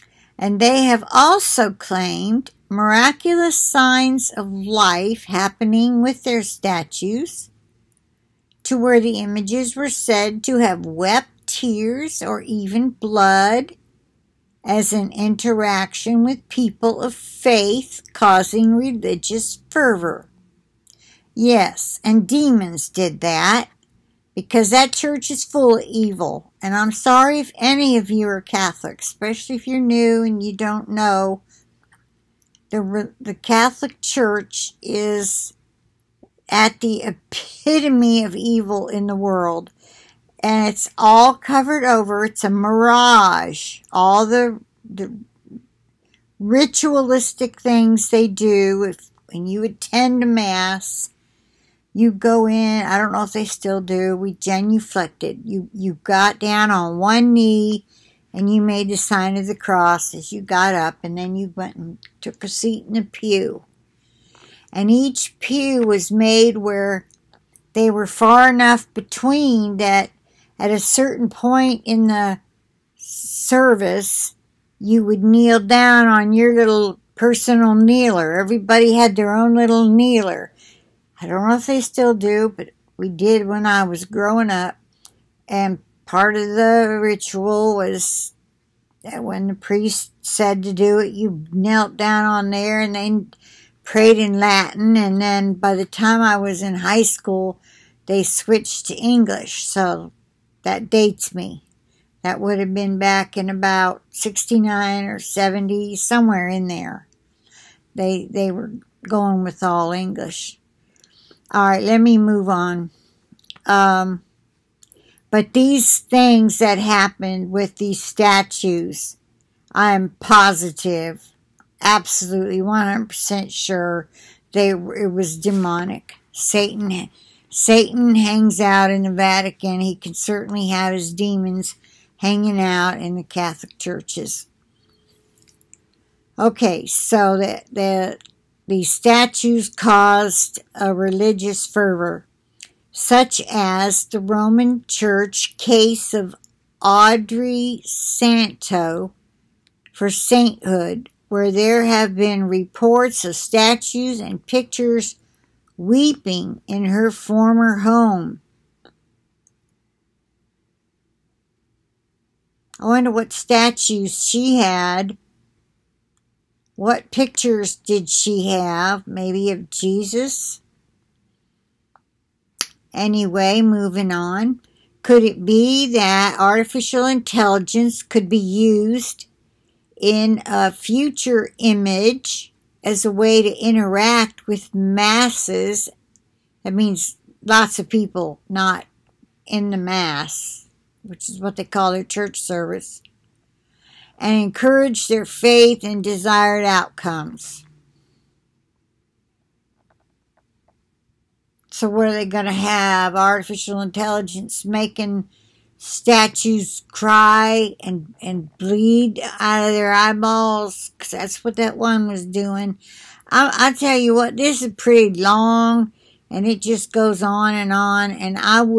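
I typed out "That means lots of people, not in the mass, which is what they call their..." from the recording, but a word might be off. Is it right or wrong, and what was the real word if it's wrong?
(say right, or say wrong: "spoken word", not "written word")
right.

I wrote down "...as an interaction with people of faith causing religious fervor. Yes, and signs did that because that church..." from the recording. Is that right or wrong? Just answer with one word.
wrong.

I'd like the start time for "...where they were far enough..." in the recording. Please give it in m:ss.
1:06.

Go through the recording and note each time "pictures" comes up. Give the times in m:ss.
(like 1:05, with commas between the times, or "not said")
2:34, 2:47.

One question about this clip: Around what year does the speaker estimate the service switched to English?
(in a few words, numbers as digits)
1969.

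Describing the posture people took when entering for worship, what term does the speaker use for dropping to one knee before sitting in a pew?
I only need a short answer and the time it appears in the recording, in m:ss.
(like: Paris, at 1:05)
Genuflected, at 0:54.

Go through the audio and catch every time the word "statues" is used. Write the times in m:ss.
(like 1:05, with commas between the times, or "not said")
0:06, 1:58, 2:18, 2:33, 2:43, 3:25.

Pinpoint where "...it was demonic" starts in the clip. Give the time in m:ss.
2:04.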